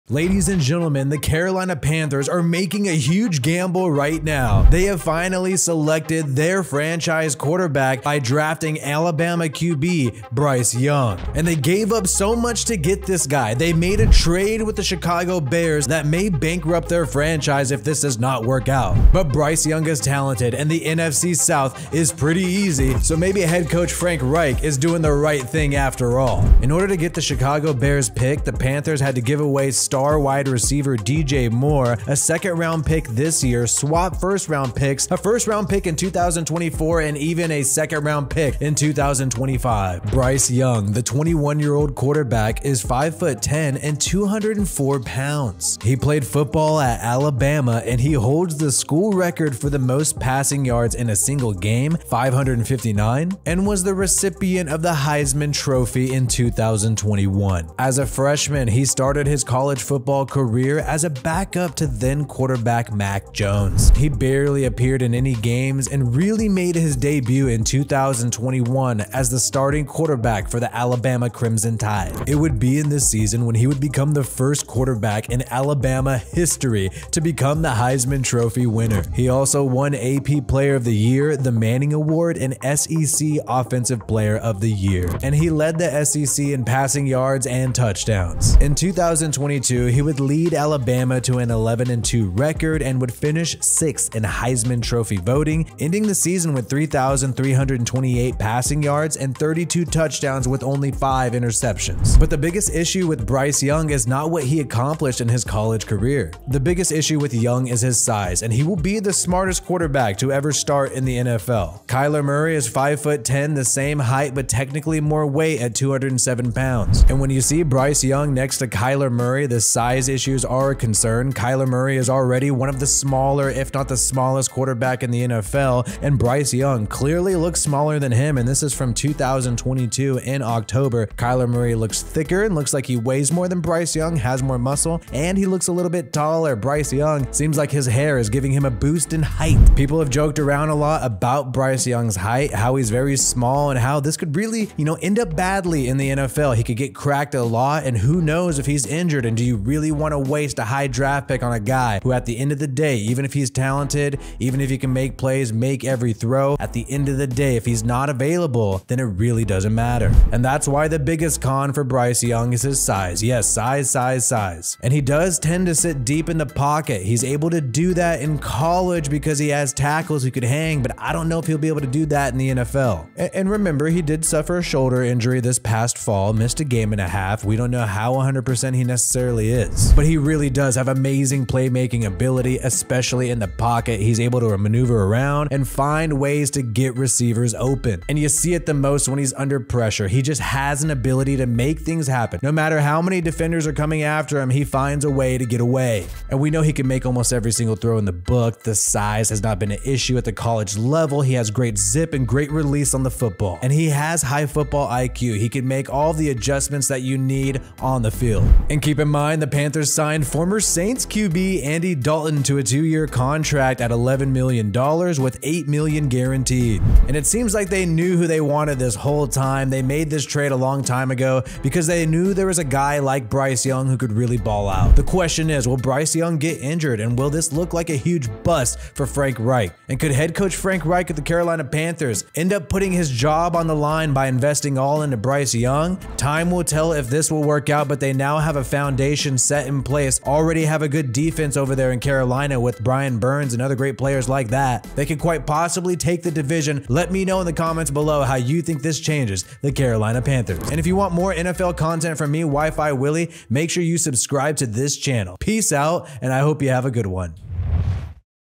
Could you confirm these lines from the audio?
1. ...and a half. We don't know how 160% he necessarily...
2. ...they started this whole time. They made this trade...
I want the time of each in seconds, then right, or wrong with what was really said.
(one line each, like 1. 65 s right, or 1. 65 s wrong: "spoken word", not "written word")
1. 176 s wrong: "100", not "160"
2. 218 s wrong: "wanted", not "started".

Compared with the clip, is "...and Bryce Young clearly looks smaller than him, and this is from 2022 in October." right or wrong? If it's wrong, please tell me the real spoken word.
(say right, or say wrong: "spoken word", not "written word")
right.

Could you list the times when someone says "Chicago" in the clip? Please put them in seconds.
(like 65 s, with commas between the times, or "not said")
14 s, 27 s.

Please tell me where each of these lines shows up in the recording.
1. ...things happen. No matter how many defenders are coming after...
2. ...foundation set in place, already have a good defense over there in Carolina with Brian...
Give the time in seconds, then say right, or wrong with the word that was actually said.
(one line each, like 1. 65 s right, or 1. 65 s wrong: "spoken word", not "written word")
1. 191 s right
2. 238 s right.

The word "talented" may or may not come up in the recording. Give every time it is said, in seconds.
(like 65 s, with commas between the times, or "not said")
20 s, 153 s.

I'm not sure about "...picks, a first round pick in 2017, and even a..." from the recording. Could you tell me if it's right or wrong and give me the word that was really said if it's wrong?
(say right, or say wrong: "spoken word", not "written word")
wrong: "2024", not "2017".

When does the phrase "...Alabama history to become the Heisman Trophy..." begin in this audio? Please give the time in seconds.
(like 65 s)
75 s.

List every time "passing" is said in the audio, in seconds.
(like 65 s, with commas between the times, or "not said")
50 s, 86 s, 98 s.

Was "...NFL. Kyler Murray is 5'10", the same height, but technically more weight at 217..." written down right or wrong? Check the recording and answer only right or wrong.
wrong.